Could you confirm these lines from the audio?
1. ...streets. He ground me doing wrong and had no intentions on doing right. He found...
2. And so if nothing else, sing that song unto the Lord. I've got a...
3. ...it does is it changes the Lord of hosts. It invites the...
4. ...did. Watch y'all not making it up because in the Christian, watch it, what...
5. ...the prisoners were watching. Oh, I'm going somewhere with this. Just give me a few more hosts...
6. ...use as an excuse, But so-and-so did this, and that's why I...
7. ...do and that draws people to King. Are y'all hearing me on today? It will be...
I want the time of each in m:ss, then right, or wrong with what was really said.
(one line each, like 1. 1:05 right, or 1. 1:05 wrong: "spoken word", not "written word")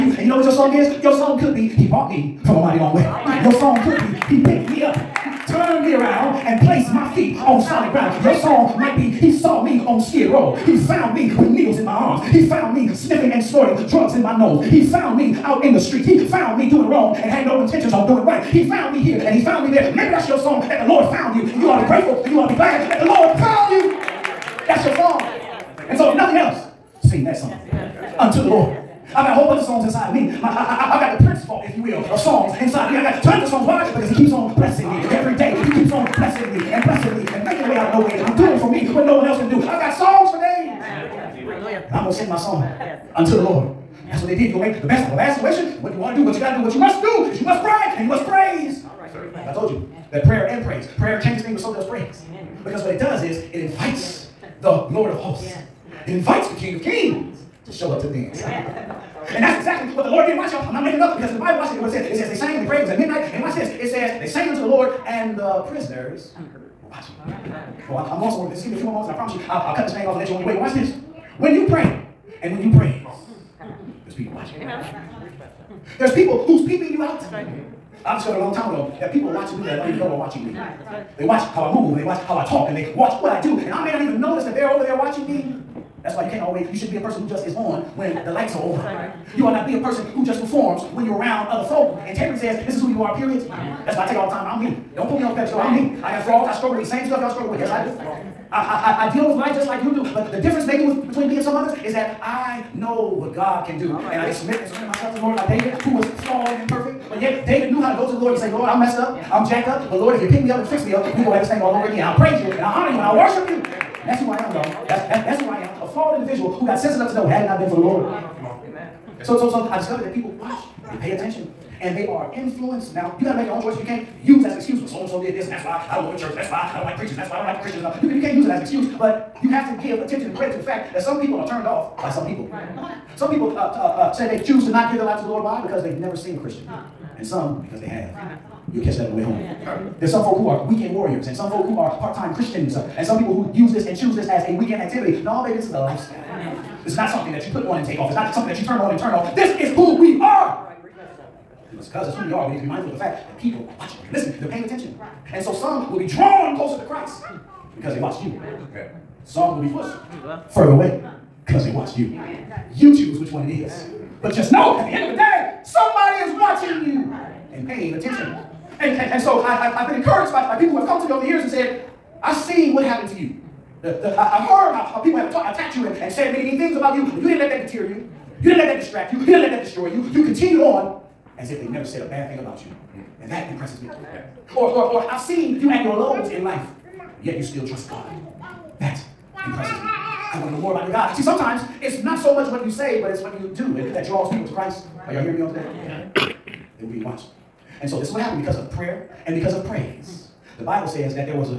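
1. 0:15 wrong: "found", not "ground"
2. 0:25 right
3. 0:52 wrong: "invites", not "changes"
4. 1:00 wrong: "Bible", not "Christian"
5. 1:05 wrong: "moments", not "hosts"
6. 2:04 right
7. 3:13 wrong: "Christ", not "King".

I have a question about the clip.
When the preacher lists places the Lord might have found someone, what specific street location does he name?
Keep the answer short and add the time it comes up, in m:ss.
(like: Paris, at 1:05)
Skid Row, at 0:09.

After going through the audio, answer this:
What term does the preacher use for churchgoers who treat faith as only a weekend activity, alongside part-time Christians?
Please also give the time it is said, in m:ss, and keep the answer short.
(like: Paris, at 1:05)
Weekend warriors, at 2:20.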